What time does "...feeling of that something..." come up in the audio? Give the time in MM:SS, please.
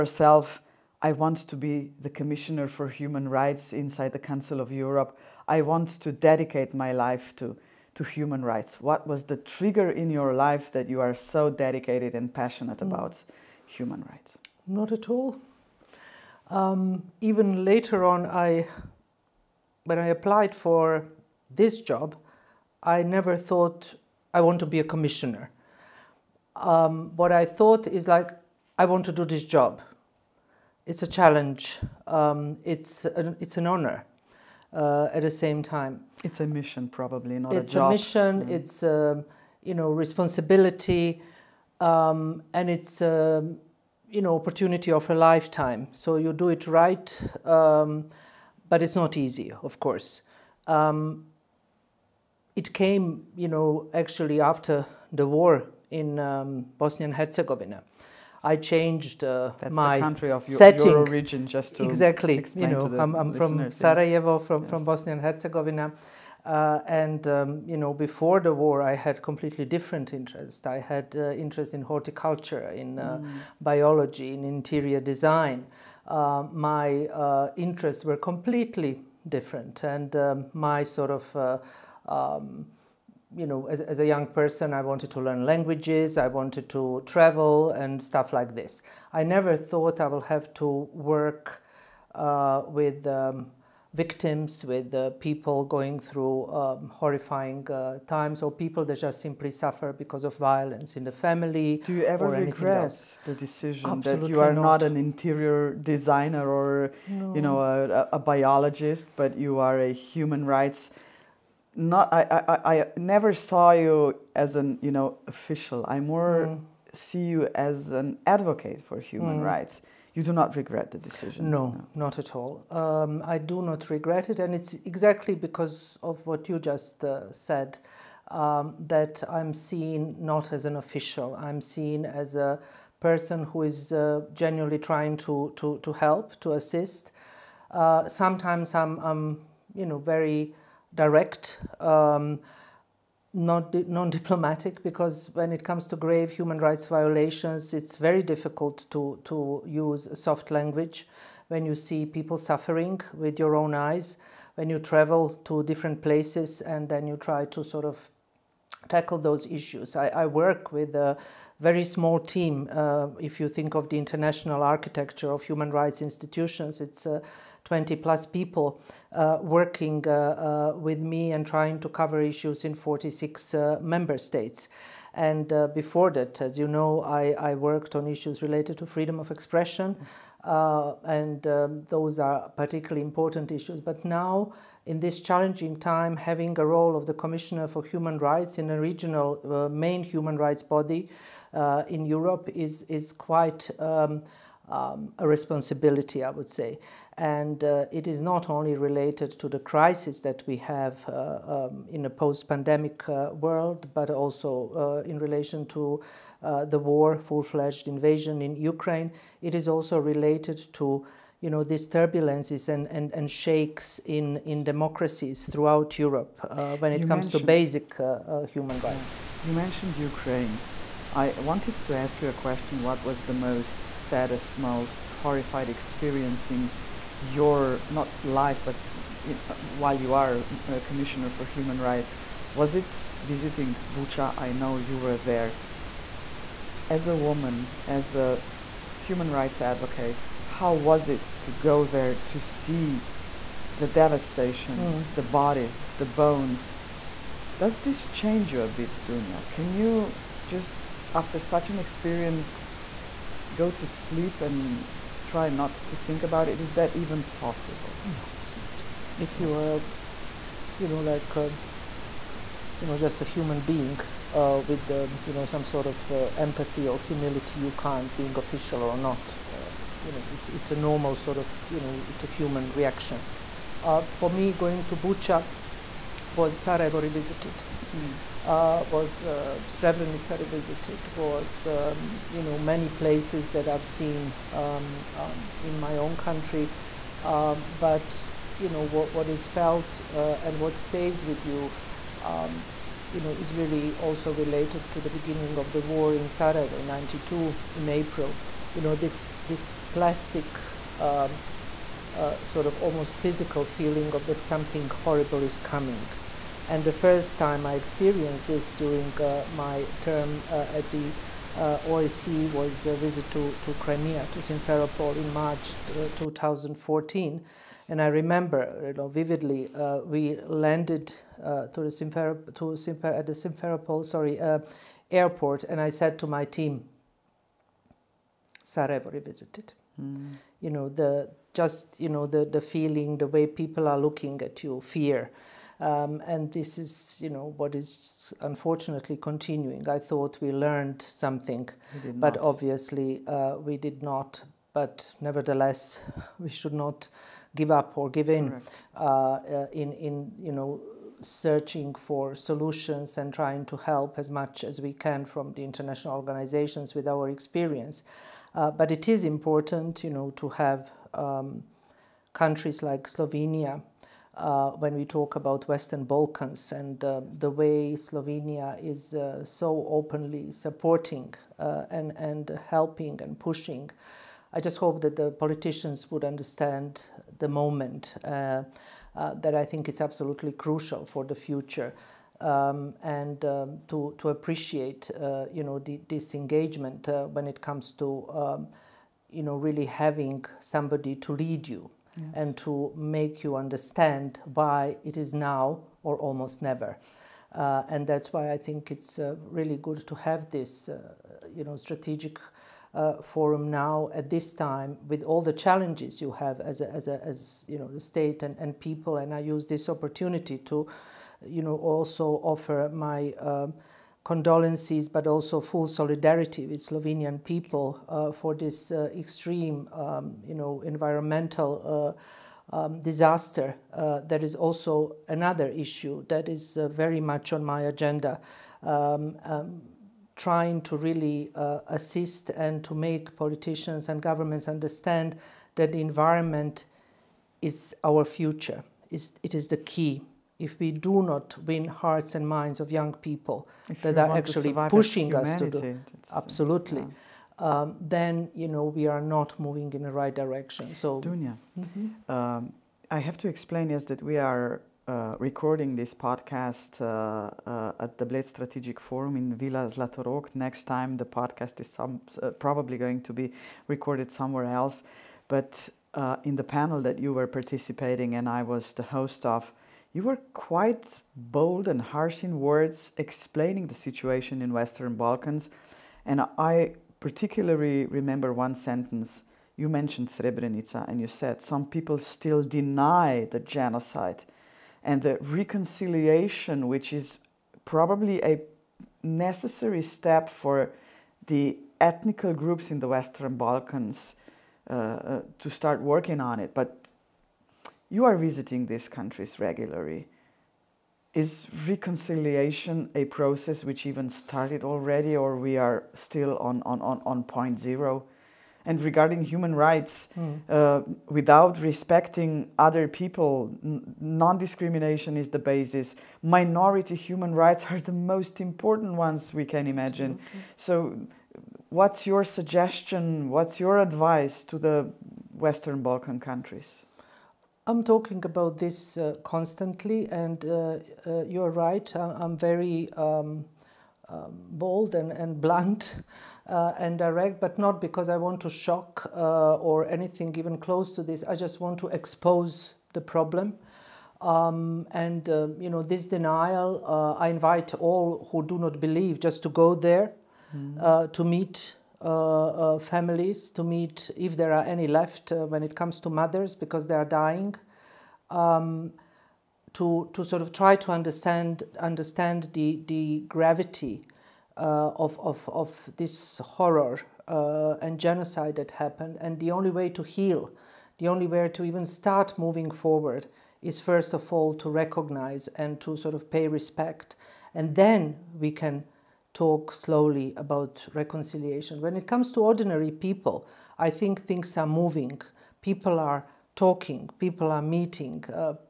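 05:03.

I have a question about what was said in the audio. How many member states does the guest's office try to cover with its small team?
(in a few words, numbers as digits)
46.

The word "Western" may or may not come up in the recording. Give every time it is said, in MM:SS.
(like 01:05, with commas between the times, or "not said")
06:05, 07:54, 08:13, 08:45.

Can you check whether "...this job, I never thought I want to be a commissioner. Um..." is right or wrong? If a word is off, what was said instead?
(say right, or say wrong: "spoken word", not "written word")
right.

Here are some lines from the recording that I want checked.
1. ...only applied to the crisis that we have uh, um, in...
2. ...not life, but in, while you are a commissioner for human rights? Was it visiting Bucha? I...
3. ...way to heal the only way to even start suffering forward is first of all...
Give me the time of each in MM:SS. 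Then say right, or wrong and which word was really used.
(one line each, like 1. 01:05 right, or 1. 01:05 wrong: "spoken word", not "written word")
1. 03:18 wrong: "related", not "applied"
2. 03:47 right
3. 09:29 wrong: "moving", not "suffering".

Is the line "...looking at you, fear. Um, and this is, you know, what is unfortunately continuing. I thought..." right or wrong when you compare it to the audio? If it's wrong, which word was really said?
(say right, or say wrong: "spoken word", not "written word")
right.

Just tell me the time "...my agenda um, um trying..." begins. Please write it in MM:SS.
07:07.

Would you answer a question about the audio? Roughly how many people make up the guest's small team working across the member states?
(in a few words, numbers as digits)
20 plus.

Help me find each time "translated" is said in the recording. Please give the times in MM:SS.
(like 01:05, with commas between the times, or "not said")
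not said.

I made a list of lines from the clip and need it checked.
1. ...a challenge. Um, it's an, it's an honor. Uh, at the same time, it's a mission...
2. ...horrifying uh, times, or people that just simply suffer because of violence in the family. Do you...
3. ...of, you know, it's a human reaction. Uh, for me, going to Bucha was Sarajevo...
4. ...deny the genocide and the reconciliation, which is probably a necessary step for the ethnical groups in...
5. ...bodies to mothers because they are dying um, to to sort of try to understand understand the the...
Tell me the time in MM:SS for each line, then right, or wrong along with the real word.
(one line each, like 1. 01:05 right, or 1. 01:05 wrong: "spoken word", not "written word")
1. 00:31 right
2. 01:36 right
3. 04:31 right
4. 08:02 right
5. 09:15 wrong: "comes", not "bodies".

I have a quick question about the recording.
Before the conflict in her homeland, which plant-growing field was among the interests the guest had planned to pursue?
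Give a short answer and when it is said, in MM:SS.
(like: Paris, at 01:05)
Horticulture, at 01:11.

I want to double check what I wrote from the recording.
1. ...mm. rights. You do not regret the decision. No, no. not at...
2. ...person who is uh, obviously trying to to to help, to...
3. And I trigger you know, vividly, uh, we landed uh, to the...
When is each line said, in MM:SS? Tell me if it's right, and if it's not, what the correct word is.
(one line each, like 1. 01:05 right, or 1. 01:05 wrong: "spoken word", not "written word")
1. 01:59 right
2. 02:12 wrong: "genuinely", not "obviously"
3. 05:17 wrong: "remember", not "trigger".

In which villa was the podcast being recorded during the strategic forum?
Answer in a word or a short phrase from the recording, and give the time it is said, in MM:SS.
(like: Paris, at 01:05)
Villa Zlatorog, at 07:39.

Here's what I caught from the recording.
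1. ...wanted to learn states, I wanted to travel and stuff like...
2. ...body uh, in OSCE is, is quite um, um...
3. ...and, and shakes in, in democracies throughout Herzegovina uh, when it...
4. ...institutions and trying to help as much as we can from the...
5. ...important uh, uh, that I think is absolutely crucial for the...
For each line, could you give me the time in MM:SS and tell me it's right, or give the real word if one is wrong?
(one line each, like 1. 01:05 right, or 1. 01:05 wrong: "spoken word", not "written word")
1. 01:24 wrong: "languages", not "states"
2. 03:10 wrong: "Europe", not "OSCE"
3. 03:32 wrong: "Europe", not "Herzegovina"
4. 05:52 wrong: "solutions", not "institutions"
5. 06:17 wrong: "moment", not "important".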